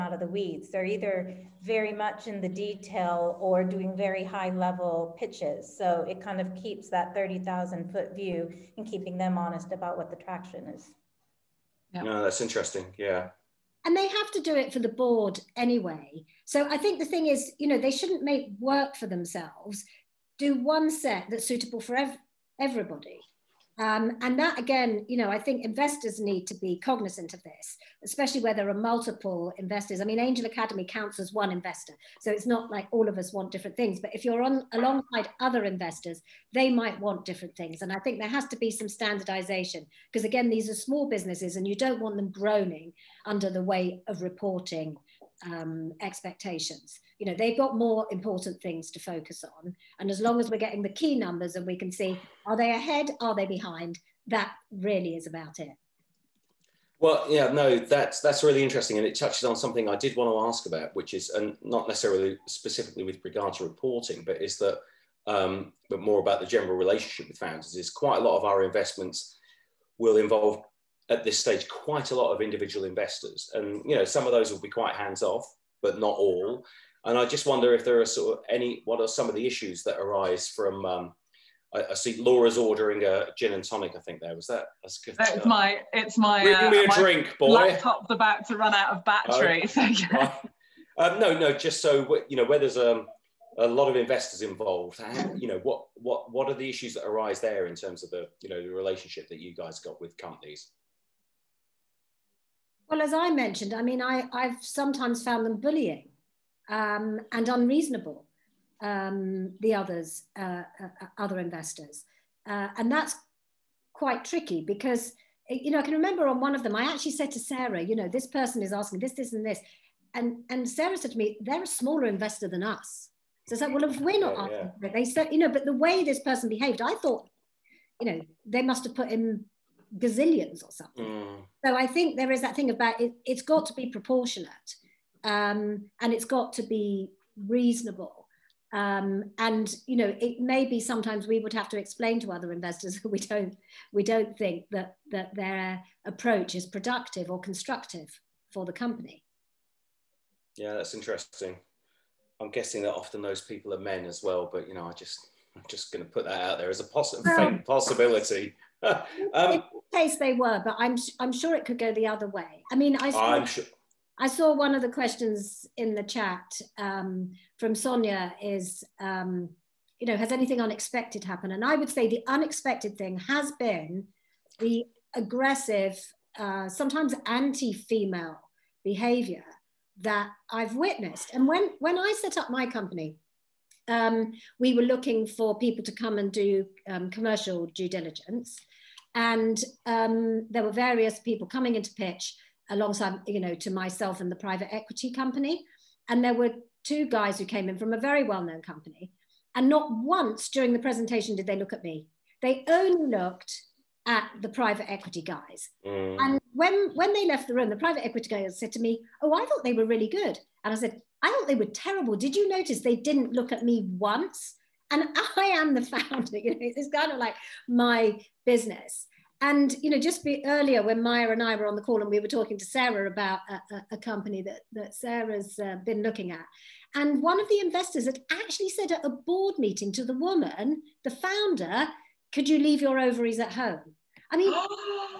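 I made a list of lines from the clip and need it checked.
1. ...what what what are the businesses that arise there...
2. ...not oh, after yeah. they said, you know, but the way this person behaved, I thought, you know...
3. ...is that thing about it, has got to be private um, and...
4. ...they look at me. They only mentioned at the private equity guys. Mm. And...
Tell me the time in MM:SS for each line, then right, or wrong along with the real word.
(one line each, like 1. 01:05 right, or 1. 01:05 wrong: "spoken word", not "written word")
1. 01:35 wrong: "issues", not "businesses"
2. 02:04 right
3. 02:12 wrong: "proportionate", not "private"
4. 03:21 wrong: "looked", not "mentioned".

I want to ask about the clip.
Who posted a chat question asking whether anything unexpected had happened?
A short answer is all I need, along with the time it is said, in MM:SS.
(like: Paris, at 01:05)
Sonia, at 02:47.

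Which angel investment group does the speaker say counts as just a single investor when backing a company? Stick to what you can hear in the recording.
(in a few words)
Angel Academe.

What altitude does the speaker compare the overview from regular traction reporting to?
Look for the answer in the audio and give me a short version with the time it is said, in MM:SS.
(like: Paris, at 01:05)
30,000 feet, at 00:07.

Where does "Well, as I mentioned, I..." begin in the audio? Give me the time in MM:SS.
01:42.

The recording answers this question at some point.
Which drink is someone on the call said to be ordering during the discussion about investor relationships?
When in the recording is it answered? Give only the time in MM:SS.
01:23.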